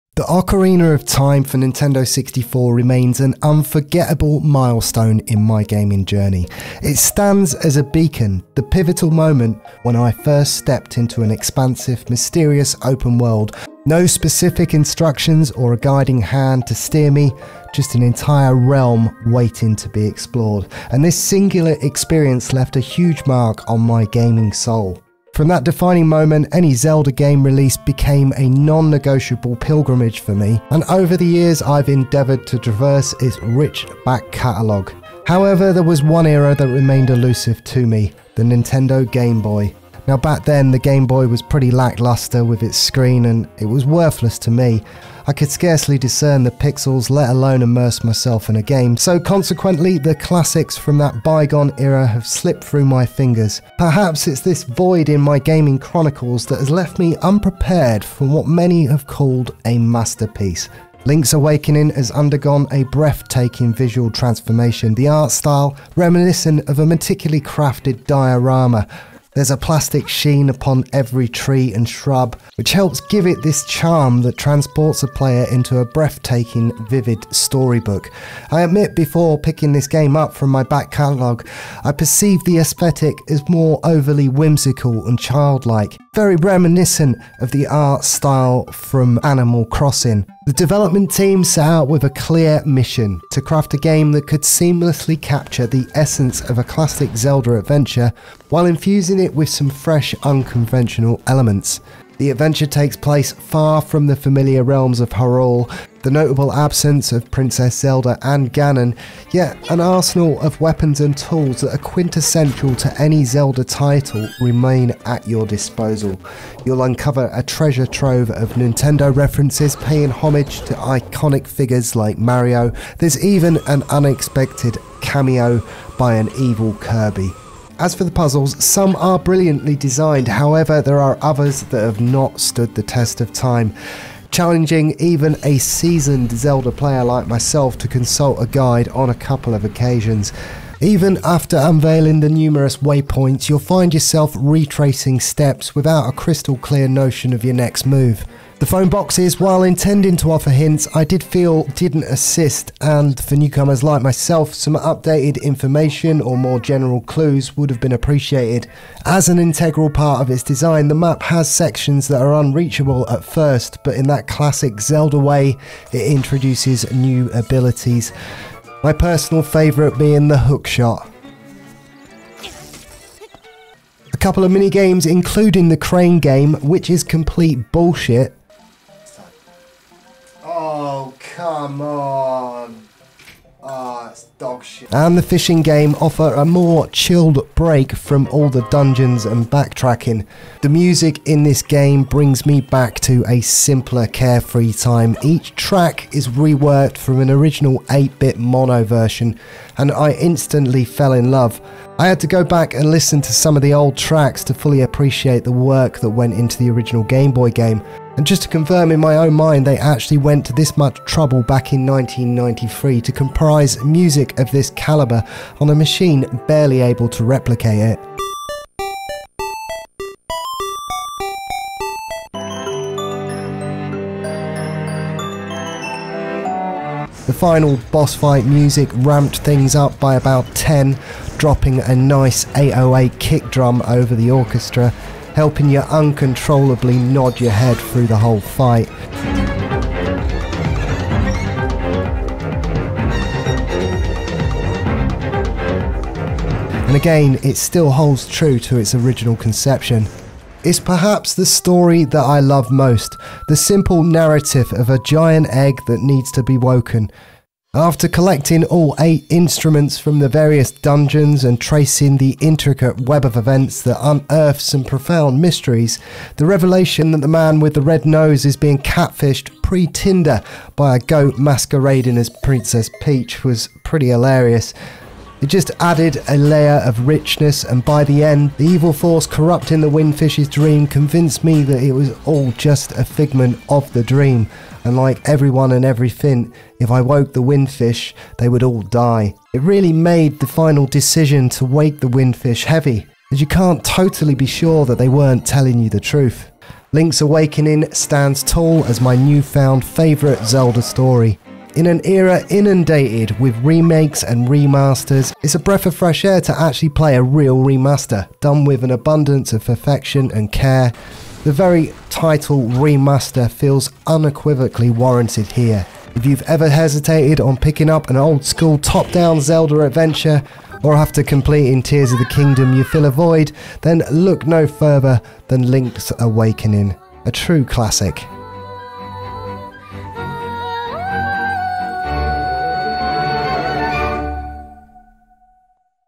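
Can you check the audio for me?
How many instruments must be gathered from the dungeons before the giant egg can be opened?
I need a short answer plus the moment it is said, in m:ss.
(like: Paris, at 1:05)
8, at 4:18.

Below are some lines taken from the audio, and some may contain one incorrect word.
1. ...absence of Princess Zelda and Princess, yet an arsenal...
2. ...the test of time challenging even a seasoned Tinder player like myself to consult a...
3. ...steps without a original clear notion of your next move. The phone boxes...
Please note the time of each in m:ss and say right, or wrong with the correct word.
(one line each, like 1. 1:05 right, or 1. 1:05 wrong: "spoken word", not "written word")
1. 1:46 wrong: "Ganon", not "Princess"
2. 2:12 wrong: "Zelda", not "Tinder"
3. 2:25 wrong: "crystal", not "original".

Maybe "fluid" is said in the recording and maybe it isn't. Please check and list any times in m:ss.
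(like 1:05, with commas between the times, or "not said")
not said.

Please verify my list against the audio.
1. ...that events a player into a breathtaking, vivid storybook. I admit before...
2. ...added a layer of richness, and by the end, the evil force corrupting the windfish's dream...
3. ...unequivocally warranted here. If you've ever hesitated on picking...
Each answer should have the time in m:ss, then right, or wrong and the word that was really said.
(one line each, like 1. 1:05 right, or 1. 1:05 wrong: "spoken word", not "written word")
1. 1:14 wrong: "transports", not "events"
2. 4:35 right
3. 5:14 right.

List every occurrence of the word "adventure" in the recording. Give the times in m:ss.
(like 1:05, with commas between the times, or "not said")
1:37, 1:42, 5:19.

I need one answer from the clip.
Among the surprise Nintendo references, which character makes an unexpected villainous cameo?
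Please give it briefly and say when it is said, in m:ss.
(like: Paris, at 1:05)
Kirby, at 2:06.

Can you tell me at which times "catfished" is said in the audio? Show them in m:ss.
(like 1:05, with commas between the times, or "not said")
4:28.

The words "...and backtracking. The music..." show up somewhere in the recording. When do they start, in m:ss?
3:09.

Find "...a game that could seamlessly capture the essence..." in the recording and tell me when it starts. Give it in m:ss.
1:33.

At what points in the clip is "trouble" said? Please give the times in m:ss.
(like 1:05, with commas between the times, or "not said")
3:31.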